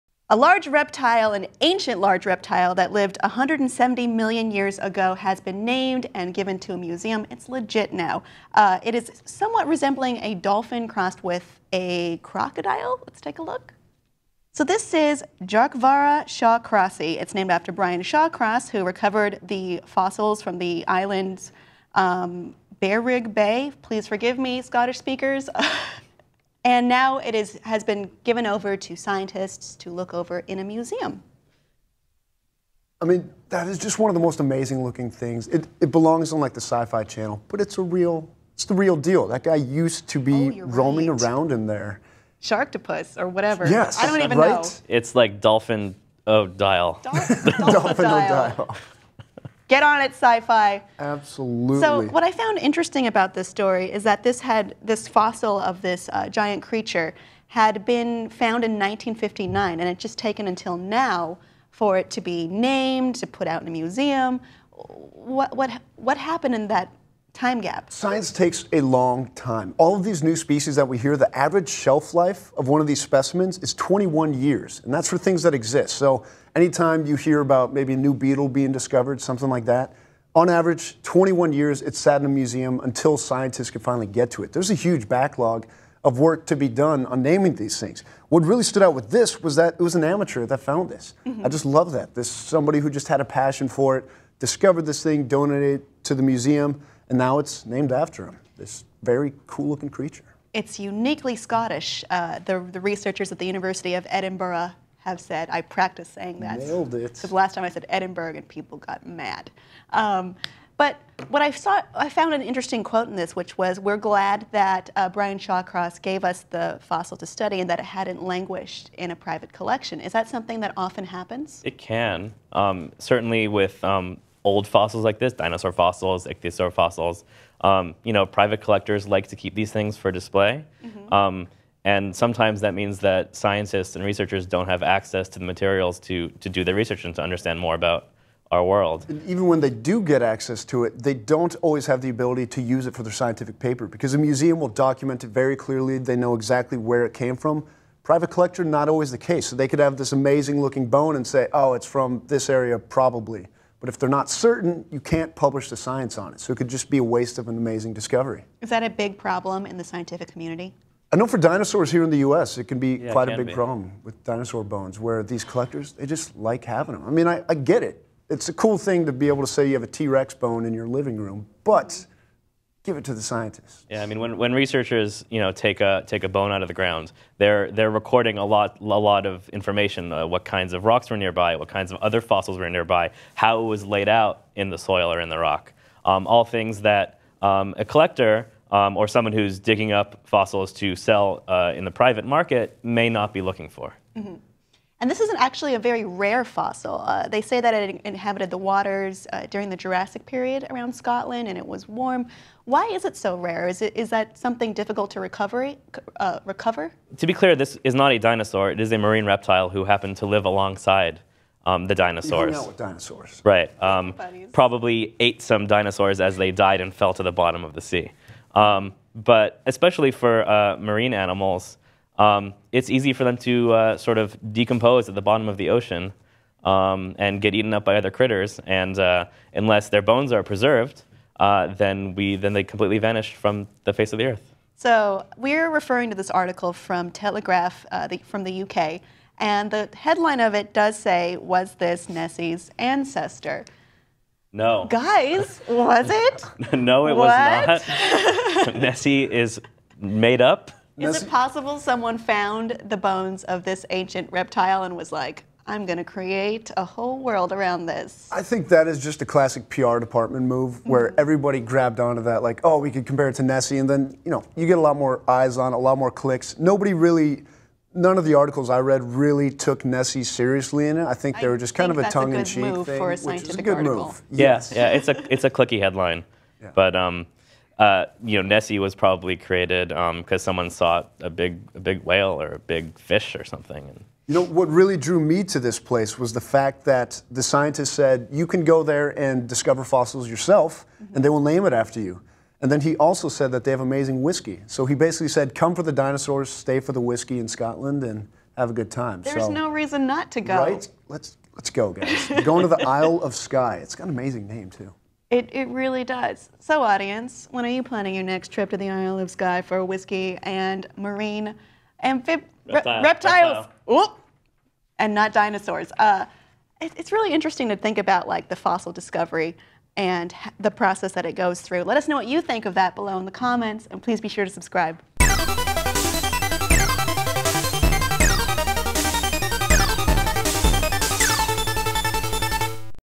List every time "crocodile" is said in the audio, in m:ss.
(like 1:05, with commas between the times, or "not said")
0:12.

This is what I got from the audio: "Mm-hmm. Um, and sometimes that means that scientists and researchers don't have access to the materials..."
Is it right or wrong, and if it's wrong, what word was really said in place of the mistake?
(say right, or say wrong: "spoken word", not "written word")
right.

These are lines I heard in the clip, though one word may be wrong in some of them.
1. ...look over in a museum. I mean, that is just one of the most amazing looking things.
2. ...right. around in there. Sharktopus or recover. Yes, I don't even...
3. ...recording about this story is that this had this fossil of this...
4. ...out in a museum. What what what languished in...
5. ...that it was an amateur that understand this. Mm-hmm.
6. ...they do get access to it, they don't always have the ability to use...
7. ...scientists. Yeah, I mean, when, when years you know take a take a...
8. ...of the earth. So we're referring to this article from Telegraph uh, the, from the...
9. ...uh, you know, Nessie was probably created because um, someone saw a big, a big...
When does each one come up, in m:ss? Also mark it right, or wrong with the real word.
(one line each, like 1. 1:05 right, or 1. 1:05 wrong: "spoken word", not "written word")
1. 0:29 right
2. 0:41 wrong: "whatever", not "recover"
3. 0:52 wrong: "interesting", not "recording"
4. 1:03 wrong: "happened", not "languished"
5. 1:29 wrong: "found", not "understand"
6. 2:19 right
7. 2:53 wrong: "researchers", not "years"
8. 3:54 right
9. 4:37 right.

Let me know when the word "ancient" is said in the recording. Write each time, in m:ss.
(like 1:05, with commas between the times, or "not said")
0:01, 4:13.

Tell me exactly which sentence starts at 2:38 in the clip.
Is that a big problem in the scientific community?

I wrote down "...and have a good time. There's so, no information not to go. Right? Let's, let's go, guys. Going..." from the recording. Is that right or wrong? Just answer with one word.
wrong.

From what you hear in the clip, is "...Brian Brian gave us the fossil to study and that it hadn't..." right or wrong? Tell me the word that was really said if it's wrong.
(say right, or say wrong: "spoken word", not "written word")
wrong: "Shawcross", not "Brian".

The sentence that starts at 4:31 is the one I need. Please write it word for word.
I think they were just kind of a tongue in cheek move thing.